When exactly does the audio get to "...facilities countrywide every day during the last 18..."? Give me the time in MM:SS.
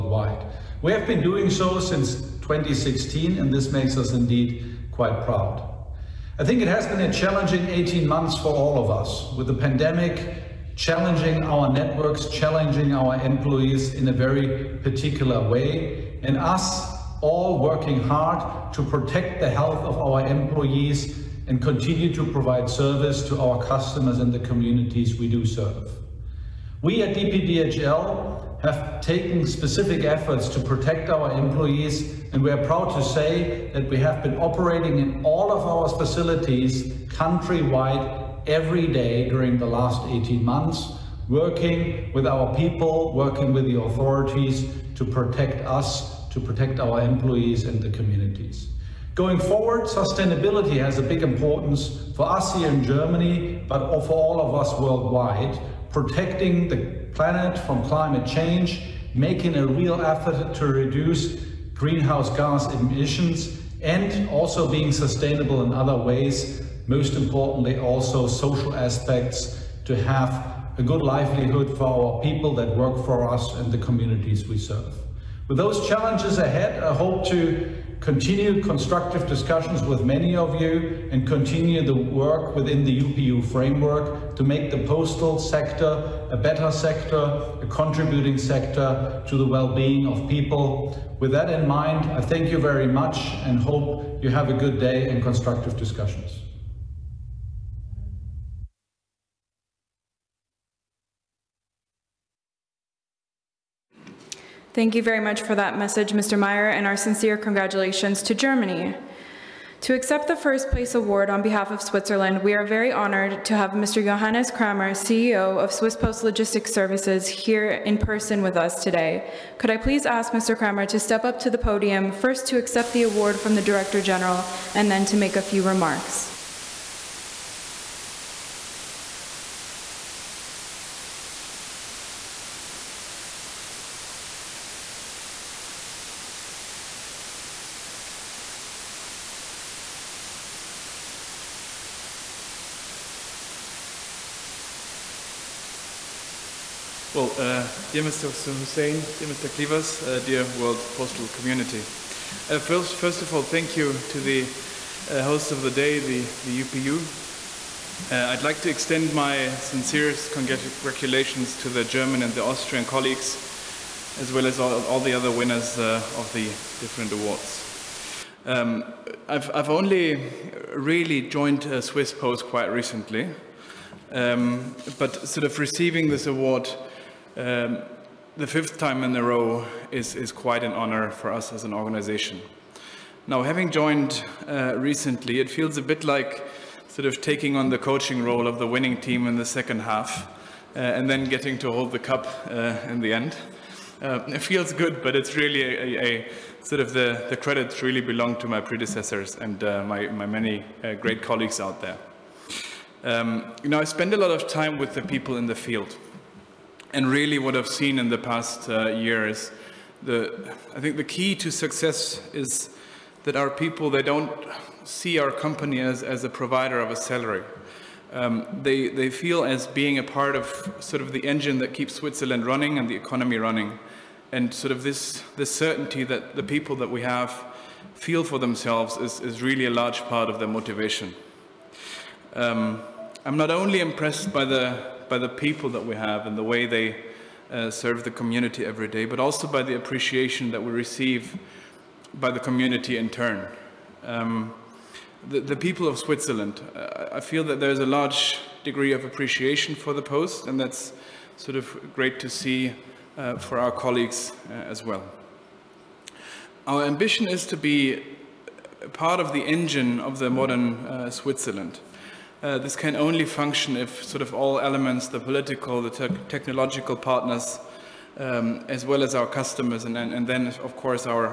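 00:35.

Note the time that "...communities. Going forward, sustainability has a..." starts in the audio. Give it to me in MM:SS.
00:47.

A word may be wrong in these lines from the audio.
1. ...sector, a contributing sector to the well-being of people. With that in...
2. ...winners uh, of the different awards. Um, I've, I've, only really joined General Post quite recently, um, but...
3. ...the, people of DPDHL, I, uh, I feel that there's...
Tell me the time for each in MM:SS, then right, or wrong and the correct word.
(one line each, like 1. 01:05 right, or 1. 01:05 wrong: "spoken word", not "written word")
1. 01:26 right
2. 02:45 wrong: "Swiss", not "General"
3. 04:05 wrong: "Switzerland", not "DPDHL".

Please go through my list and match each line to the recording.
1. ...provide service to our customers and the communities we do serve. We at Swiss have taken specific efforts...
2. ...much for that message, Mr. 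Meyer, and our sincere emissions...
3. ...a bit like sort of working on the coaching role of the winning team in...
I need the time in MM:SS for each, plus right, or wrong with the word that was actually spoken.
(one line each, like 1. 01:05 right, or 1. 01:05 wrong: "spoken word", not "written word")
1. 00:22 wrong: "DPDHL", not "Swiss"
2. 01:45 wrong: "congratulations", not "emissions"
3. 03:05 wrong: "taking", not "working".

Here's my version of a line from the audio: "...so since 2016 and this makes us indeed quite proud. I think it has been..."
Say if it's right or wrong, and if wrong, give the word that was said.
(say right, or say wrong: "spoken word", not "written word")
right.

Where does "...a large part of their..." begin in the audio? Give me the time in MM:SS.
03:49.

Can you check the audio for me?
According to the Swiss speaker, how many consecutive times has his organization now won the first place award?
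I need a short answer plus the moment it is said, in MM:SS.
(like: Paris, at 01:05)
5, at 02:58.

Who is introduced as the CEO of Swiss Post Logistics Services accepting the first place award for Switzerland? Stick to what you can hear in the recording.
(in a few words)
Johannes Kramer.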